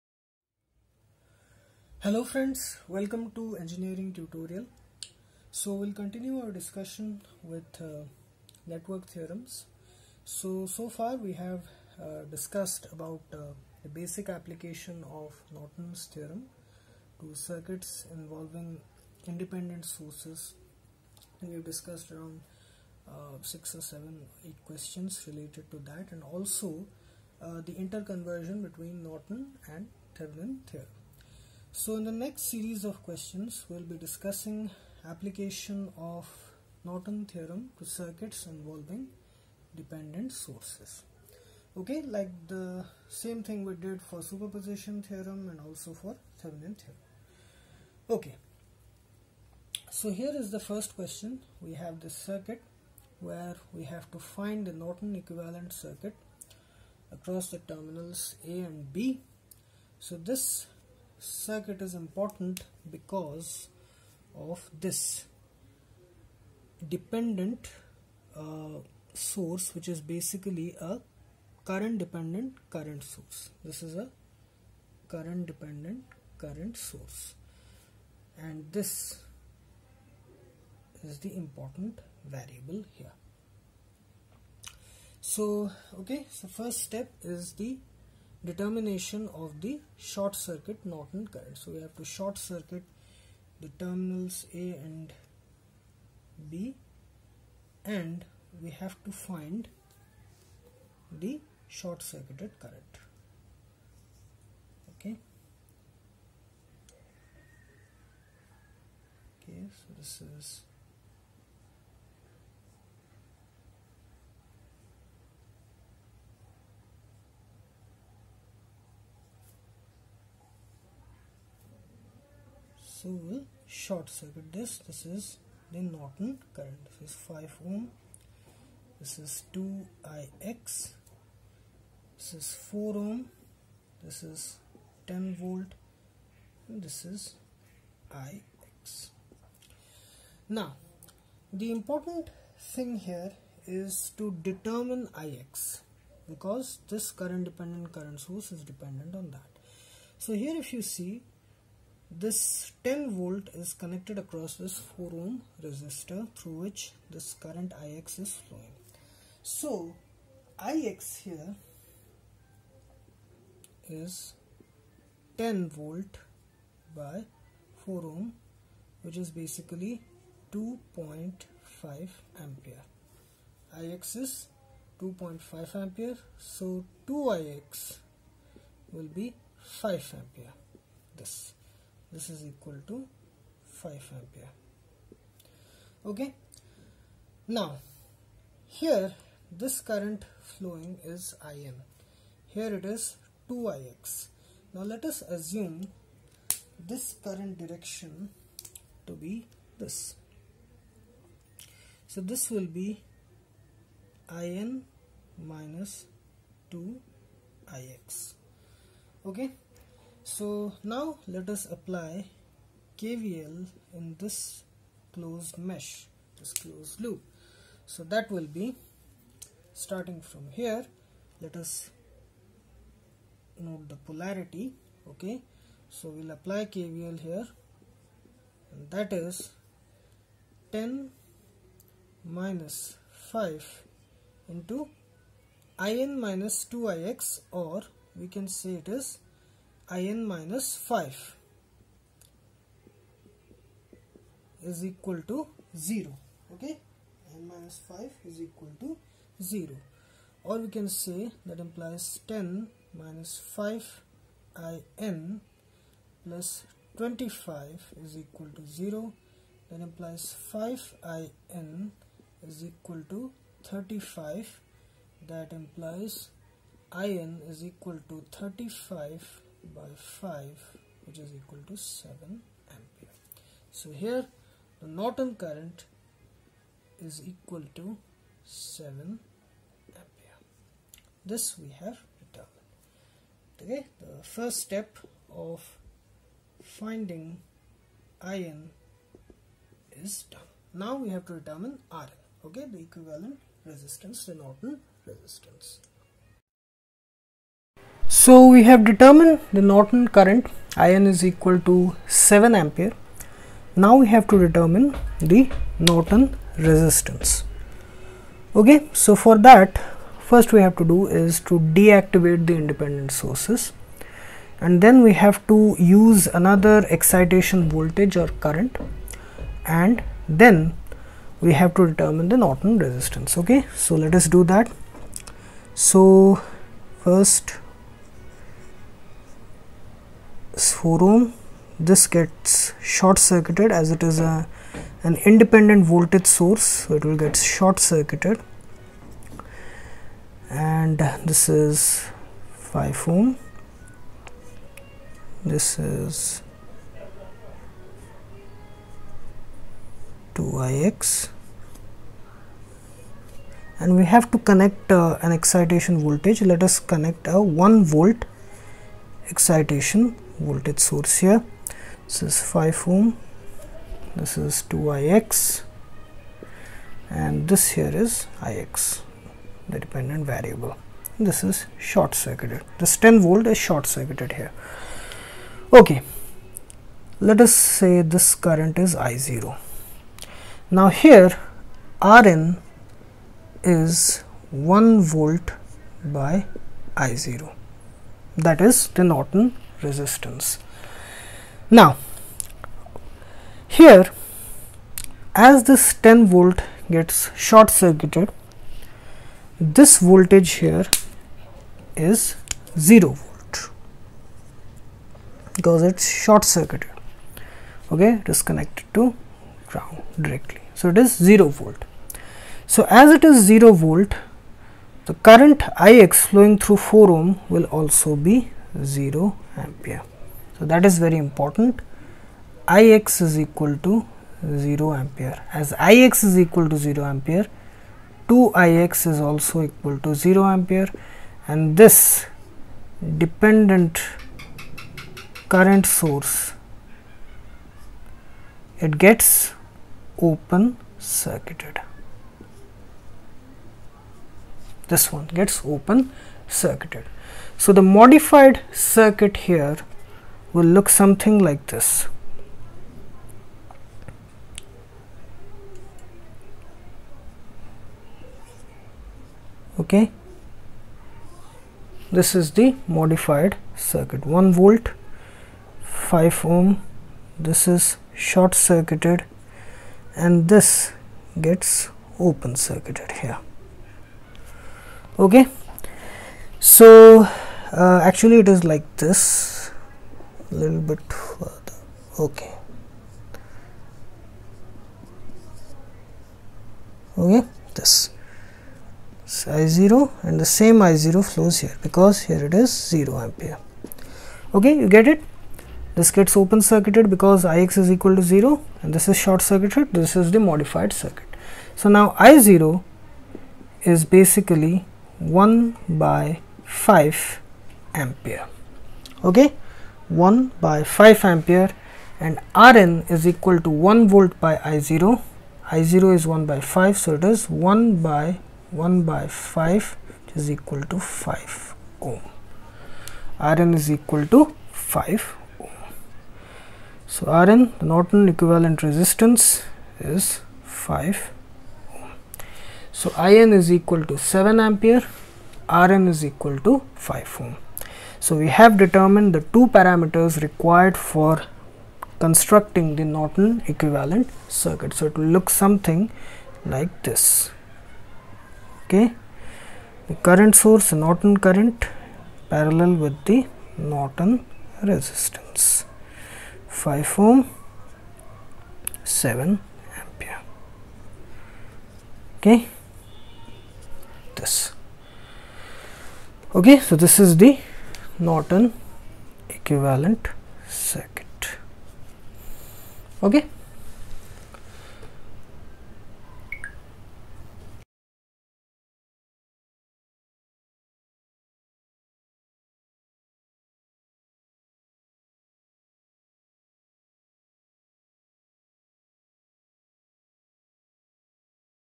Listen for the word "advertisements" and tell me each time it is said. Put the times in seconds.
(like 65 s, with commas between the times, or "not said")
not said.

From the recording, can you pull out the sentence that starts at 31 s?
So in the next series of questions, we'll be discussing application of Norton theorem to circuits involving dependent sources.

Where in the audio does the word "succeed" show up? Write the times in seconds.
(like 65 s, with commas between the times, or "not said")
not said.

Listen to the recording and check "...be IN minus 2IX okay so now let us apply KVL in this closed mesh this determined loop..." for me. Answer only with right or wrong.
wrong.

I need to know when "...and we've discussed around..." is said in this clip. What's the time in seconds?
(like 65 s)
21 s.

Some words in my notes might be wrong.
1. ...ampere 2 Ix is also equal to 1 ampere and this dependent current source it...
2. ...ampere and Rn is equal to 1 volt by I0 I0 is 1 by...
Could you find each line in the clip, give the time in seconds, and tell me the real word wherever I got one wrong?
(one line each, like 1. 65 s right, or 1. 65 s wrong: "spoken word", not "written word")
1. 427 s wrong: "0", not "1"
2. 511 s right.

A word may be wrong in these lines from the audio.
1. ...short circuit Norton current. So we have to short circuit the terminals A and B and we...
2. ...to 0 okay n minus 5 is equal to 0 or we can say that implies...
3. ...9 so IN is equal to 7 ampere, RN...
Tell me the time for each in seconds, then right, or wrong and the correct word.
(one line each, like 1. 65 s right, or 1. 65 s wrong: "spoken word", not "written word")
1. 89 s right
2. 245 s right
3. 530 s wrong: "5", not "9".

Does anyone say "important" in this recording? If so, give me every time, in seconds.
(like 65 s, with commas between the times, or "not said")
61 s, 81 s, 141 s, 421 s.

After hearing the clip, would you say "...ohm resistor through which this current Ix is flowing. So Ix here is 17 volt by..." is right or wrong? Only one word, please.
wrong.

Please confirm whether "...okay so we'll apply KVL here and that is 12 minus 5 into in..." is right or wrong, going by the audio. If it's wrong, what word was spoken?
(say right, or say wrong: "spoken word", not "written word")
wrong: "10", not "12".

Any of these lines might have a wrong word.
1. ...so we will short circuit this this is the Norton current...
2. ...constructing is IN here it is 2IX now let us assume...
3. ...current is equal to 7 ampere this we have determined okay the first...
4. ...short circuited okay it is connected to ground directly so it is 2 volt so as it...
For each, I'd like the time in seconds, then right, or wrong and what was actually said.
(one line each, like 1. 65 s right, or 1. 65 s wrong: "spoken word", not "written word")
1. 123 s right
2. 190 s wrong: "flowing", not "constructing"
3. 275 s right
4. 406 s wrong: "0", not "2".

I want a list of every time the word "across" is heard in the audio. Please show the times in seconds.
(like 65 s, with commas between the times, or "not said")
57 s, 154 s.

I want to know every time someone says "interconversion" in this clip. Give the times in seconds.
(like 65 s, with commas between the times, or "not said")
27 s.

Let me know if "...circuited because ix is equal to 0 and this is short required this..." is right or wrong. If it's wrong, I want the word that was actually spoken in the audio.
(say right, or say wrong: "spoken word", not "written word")
wrong: "circuited", not "required".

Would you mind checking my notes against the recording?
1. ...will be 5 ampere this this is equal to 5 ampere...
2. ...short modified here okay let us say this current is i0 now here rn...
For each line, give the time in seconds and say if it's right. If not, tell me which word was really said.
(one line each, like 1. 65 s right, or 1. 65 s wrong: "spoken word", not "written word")
1. 178 s right
2. 373 s wrong: "circuited", not "modified".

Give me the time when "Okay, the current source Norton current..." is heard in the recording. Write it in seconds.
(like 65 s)
548 s.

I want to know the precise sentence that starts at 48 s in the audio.
Okay, so here is the first question.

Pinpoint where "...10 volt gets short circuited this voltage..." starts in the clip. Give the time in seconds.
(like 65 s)
396 s.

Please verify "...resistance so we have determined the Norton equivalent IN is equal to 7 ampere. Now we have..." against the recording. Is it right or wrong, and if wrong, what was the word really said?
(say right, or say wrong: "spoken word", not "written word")
wrong: "current", not "equivalent".